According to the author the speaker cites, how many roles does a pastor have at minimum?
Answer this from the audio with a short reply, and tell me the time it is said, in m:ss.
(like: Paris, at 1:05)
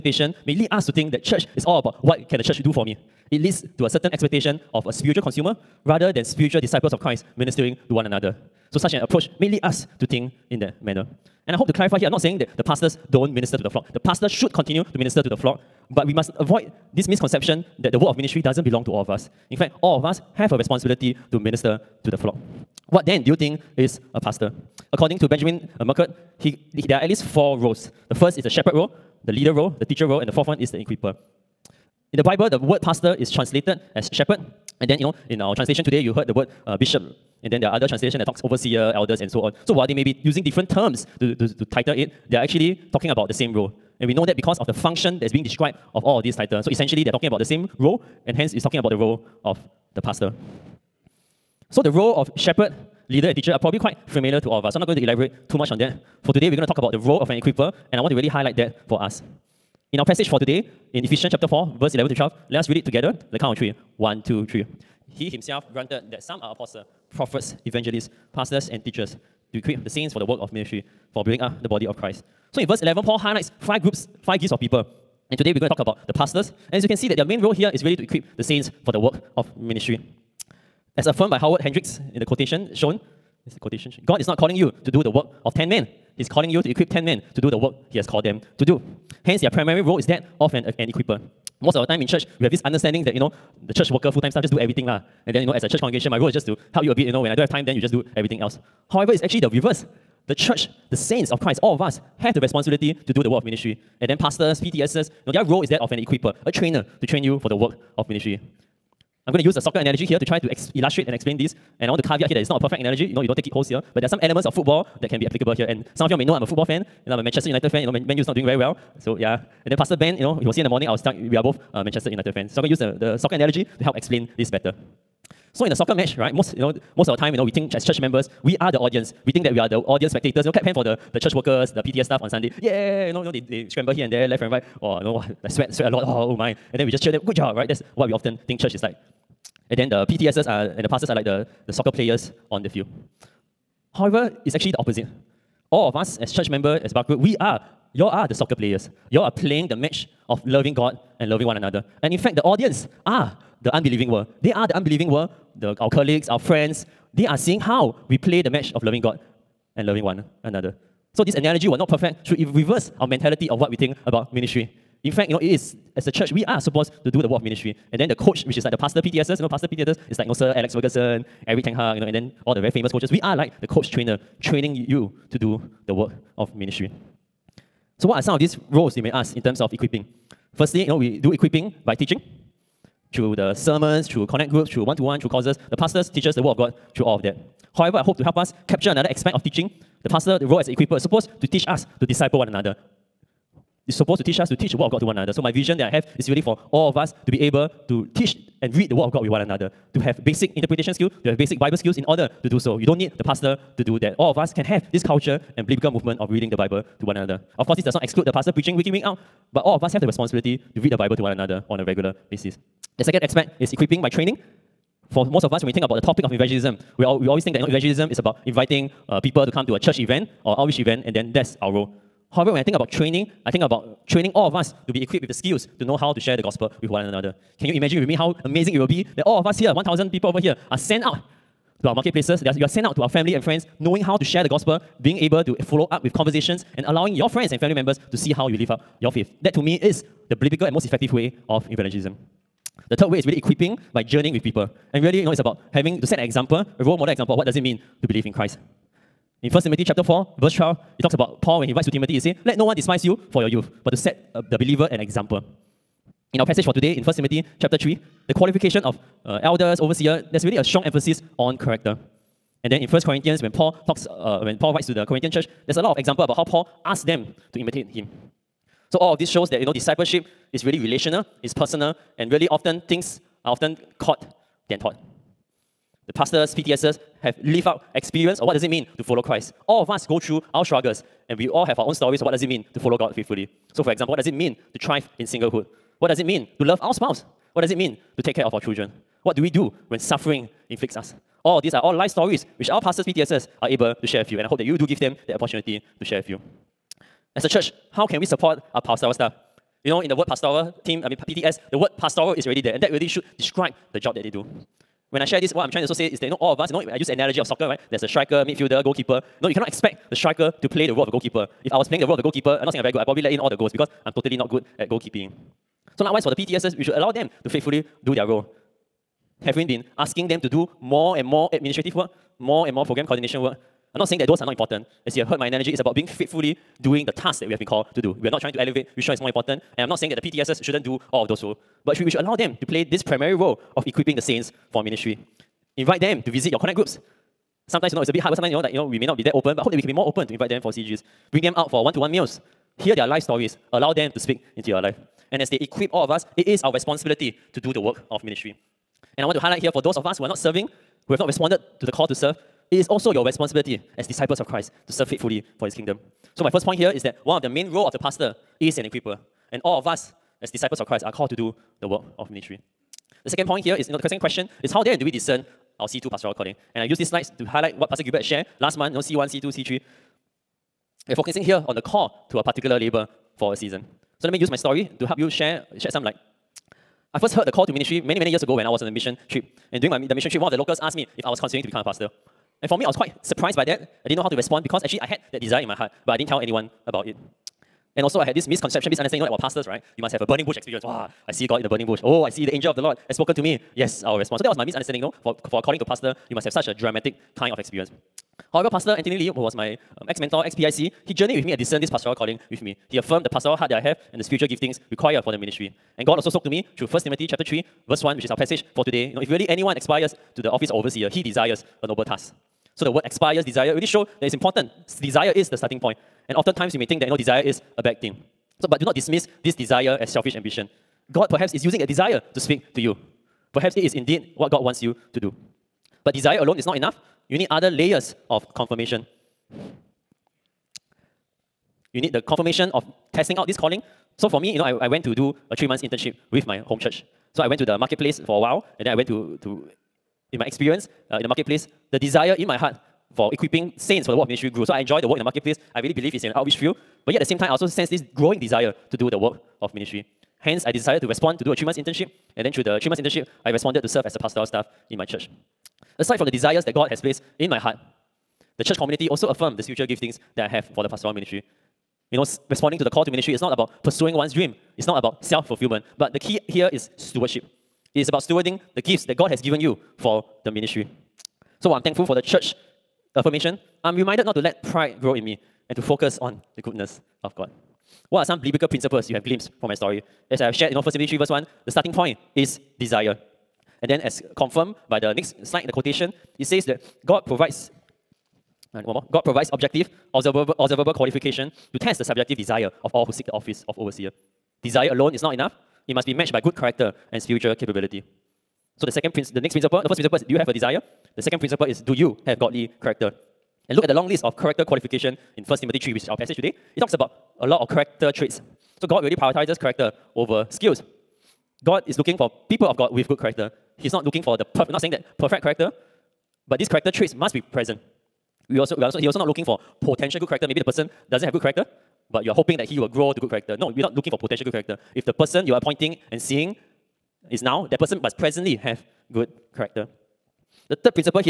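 4, at 0:27.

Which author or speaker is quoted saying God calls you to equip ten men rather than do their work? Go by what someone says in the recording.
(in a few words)
Howard Hendricks.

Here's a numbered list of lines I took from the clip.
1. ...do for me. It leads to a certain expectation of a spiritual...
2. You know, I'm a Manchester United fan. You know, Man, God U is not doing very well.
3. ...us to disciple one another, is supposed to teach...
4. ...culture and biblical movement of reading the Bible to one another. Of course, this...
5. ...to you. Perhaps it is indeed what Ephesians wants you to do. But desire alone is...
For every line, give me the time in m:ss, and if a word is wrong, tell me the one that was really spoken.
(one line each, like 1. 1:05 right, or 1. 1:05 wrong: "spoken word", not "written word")
1. 0:02 right
2. 1:57 wrong: "Man", not "God"
3. 3:11 right
4. 3:25 right
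5. 7:02 wrong: "God", not "Ephesians".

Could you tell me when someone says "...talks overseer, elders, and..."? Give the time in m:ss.
0:38.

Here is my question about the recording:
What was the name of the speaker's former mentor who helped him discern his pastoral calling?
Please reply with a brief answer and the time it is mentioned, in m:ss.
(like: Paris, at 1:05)
Anthony Lee, at 6:38.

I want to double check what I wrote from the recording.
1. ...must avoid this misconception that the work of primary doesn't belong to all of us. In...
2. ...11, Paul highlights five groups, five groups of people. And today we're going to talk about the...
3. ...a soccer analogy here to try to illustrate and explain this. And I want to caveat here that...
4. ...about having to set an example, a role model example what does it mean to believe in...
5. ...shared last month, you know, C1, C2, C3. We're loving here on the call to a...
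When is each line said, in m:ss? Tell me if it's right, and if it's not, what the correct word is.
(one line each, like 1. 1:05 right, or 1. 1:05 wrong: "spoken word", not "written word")
1. 0:16 wrong: "ministry", not "primary"
2. 1:12 right
3. 1:49 right
4. 4:05 right
5. 6:08 wrong: "focusing", not "loving".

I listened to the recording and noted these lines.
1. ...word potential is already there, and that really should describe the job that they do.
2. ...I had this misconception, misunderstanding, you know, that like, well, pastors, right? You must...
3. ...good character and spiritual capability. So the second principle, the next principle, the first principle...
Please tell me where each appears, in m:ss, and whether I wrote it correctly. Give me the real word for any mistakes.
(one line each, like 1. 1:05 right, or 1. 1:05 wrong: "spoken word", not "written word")
1. 5:01 wrong: "pastoral", not "potential"
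2. 6:28 right
3. 8:16 right.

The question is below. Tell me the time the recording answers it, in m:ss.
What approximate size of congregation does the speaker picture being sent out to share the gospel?
3:49.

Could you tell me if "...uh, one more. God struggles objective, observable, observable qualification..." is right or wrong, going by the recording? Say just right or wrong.
wrong.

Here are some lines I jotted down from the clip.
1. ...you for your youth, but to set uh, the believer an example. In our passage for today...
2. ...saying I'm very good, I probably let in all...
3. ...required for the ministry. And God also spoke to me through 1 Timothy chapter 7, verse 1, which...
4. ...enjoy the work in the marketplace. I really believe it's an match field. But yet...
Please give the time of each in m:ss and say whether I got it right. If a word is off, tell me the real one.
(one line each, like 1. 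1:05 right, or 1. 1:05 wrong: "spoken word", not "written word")
1. 4:13 right
2. 5:12 right
3. 6:44 wrong: "3", not "7"
4. 7:24 wrong: "outreach", not "match".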